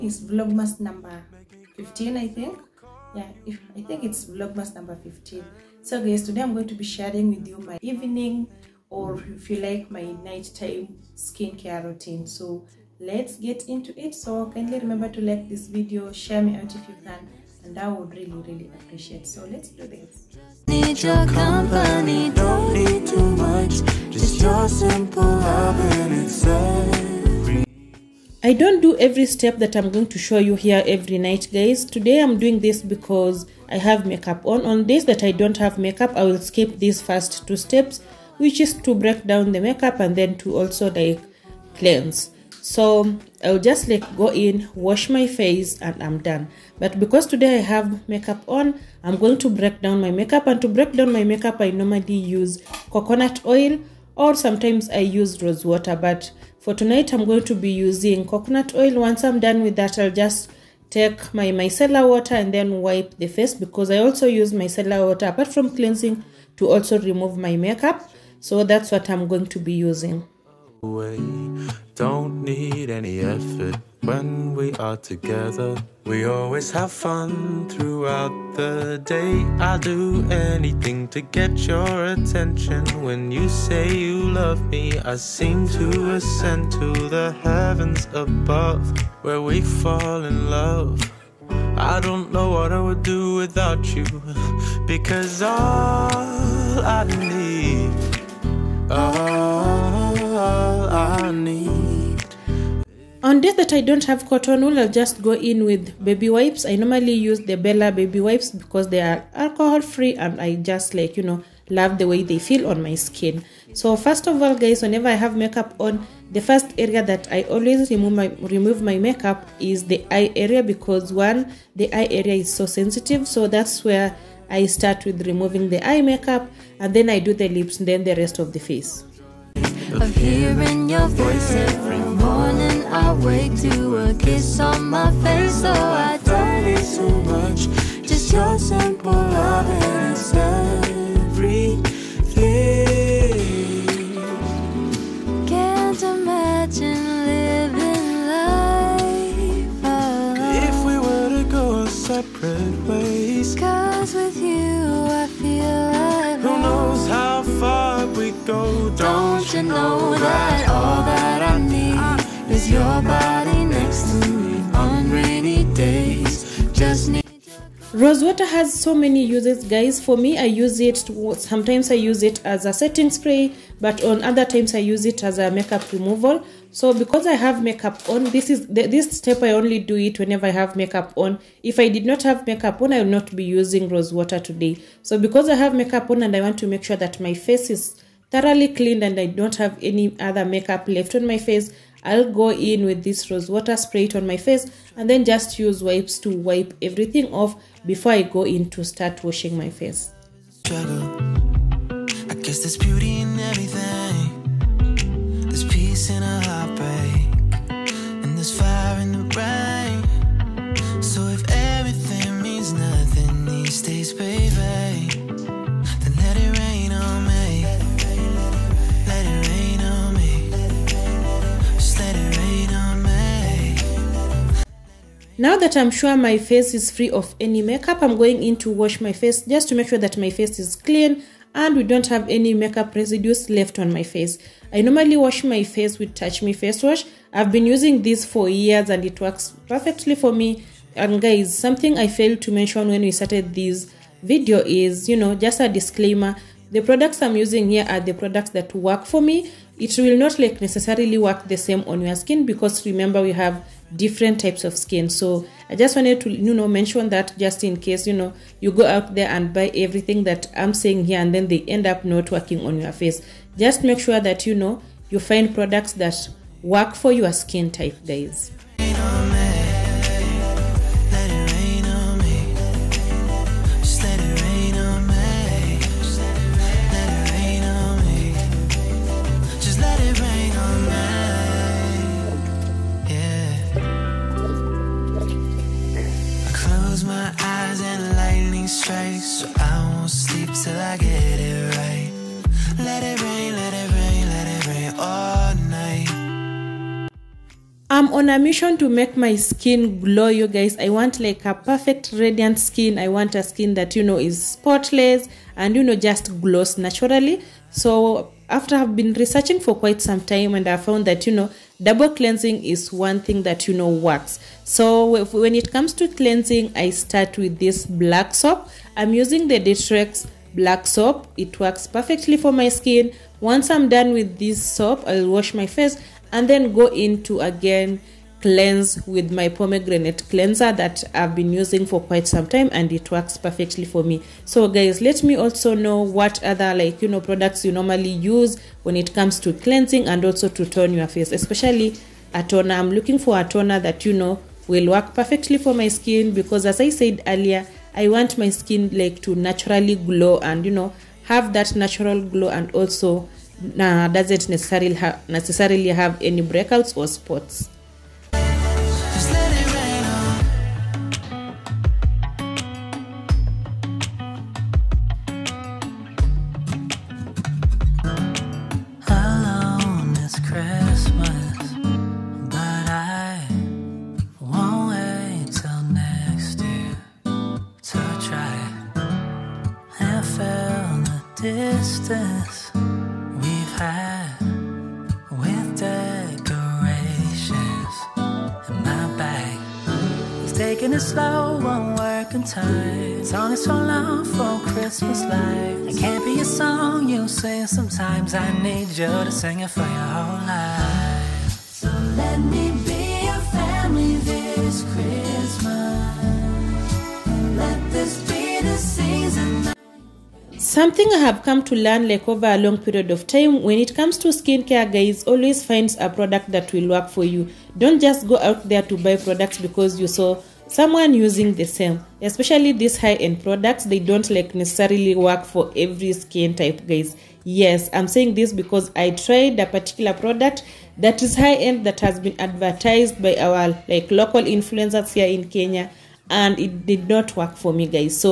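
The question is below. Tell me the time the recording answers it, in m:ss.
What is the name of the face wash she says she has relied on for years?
3:56.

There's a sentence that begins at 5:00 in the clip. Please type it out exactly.
I want like a perfect radiant skin.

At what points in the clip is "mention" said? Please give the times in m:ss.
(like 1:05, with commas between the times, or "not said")
4:02, 4:16.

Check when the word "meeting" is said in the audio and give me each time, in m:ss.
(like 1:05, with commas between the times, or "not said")
not said.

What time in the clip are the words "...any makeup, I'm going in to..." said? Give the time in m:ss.
3:47.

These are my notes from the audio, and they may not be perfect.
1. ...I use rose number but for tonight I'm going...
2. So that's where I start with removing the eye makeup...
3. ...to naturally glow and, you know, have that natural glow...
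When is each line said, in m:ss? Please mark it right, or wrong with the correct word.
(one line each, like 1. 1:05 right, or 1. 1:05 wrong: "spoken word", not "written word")
1. 0:54 wrong: "water", not "number"
2. 2:03 right
3. 5:49 right.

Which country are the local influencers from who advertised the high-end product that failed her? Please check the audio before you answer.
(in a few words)
Kenya.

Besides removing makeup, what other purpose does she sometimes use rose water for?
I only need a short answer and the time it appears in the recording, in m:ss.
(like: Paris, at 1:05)
Setting spray, at 2:52.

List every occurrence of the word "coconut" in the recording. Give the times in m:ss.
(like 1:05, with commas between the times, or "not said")
0:52, 0:58.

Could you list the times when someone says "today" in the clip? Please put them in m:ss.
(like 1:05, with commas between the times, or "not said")
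0:06, 0:31, 0:47, 3:04.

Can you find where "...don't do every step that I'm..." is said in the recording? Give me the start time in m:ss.
0:28.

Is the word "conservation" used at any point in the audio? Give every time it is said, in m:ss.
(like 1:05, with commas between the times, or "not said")
not said.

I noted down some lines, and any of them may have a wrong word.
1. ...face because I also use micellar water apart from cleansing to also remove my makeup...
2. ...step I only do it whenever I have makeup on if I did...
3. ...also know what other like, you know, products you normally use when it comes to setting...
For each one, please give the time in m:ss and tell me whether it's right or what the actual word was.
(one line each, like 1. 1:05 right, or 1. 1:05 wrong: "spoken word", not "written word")
1. 1:03 right
2. 2:59 right
3. 5:35 wrong: "cleansing", not "setting".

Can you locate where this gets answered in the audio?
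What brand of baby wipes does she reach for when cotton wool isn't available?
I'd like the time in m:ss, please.
1:47.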